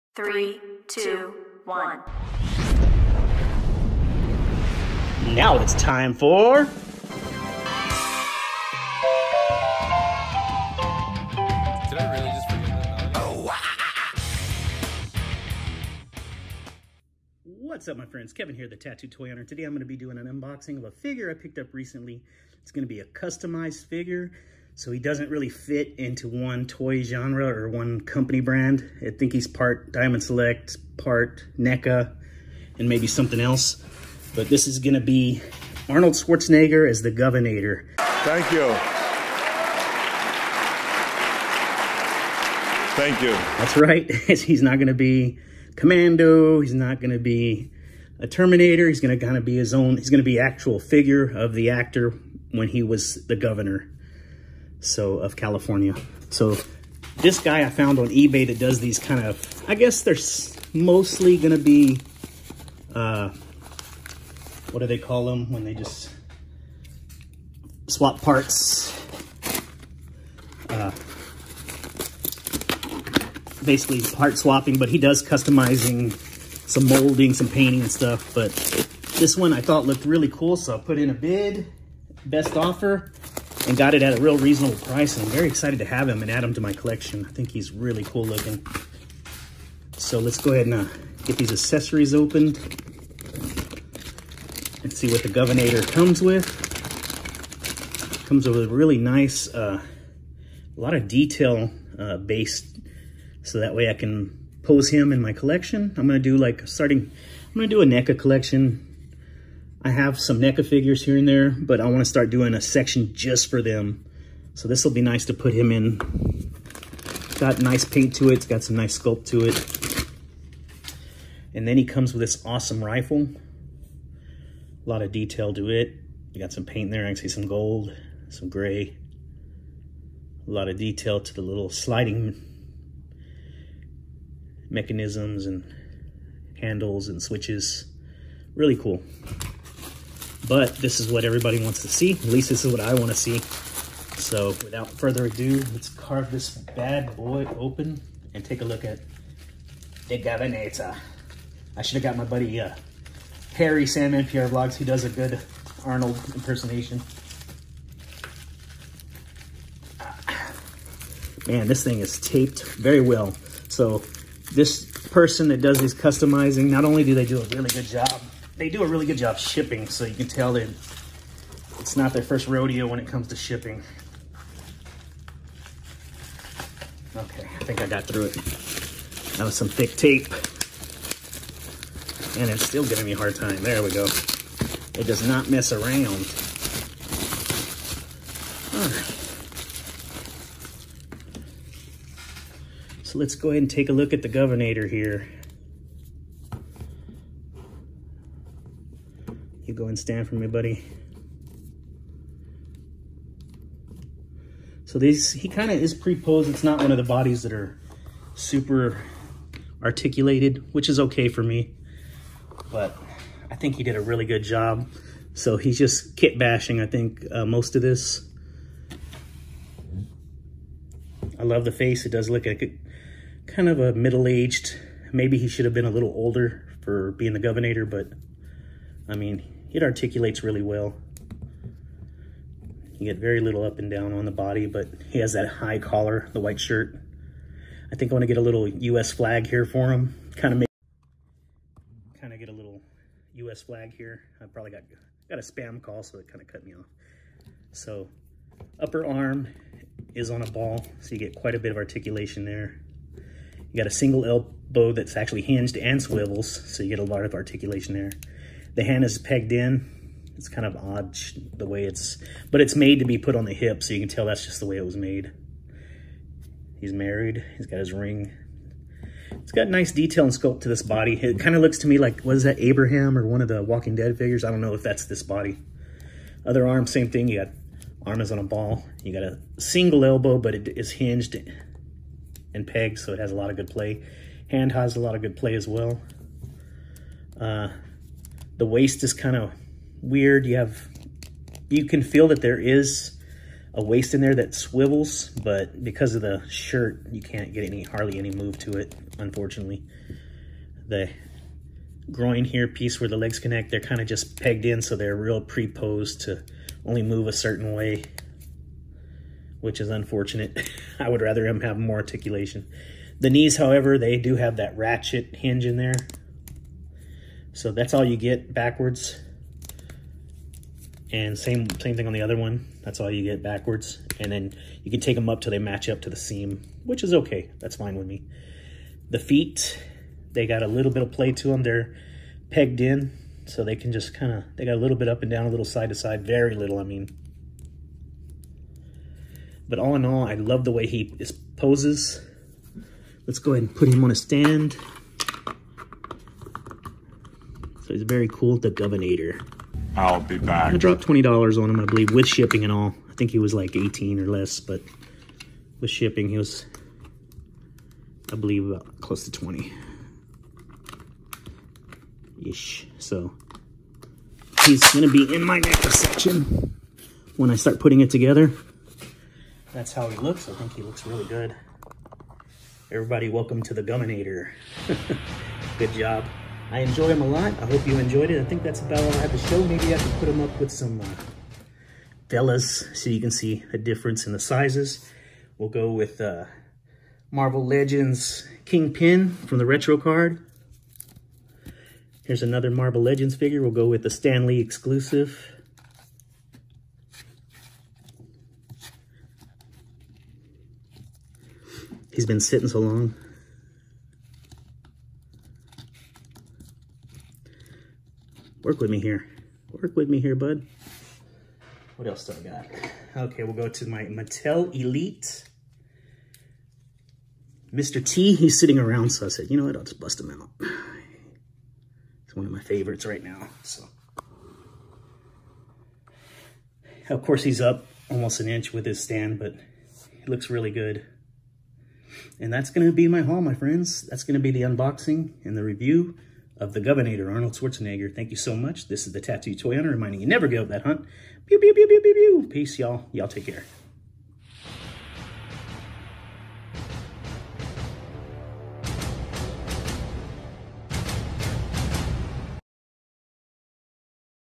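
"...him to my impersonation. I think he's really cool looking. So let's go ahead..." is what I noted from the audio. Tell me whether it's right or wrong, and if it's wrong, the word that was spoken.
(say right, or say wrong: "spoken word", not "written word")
wrong: "collection", not "impersonation".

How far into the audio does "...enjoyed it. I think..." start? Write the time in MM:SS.
06:17.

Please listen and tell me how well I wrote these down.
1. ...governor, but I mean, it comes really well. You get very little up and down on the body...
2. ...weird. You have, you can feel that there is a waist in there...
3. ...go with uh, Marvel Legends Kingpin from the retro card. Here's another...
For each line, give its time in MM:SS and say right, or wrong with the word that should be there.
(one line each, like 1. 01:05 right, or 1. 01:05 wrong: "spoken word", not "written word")
1. 03:47 wrong: "articulates", not "comes"
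2. 04:50 right
3. 06:25 right.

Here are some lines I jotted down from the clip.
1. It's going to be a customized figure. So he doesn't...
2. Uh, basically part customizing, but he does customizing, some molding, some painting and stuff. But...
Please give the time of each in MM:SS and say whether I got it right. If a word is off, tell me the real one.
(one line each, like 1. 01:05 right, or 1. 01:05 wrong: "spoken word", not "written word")
1. 00:22 right
2. 01:10 wrong: "swapping", not "customizing".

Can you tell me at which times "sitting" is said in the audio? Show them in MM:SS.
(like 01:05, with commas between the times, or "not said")
06:42, 06:58.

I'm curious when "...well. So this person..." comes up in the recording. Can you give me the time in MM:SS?
02:43.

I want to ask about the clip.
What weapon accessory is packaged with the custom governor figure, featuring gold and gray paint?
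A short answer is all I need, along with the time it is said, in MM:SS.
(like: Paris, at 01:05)
rifle, at 02:02.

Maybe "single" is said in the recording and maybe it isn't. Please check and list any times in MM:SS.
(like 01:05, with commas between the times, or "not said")
04:13, 04:39.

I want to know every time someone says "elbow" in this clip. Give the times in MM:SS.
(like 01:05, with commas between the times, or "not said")
04:14, 04:40.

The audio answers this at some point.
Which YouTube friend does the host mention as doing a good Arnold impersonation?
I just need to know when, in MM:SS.
02:33.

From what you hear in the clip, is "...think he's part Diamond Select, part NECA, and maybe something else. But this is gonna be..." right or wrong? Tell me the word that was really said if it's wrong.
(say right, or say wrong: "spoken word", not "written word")
right.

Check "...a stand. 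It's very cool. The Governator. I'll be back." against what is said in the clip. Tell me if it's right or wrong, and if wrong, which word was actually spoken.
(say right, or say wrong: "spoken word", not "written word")
right.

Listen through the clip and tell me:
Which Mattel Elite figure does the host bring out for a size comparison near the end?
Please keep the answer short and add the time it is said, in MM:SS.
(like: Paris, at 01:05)
Mr. T, at 06:57.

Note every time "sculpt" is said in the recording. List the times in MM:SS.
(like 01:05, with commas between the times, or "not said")
01:58, 04:30.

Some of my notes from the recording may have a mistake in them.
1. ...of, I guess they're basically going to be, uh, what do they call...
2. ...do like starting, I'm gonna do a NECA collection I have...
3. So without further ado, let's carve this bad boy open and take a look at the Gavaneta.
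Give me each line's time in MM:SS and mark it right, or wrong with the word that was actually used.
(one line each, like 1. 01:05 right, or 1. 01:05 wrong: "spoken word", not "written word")
1. 00:59 wrong: "mostly", not "basically"
2. 01:46 right
3. 02:24 right.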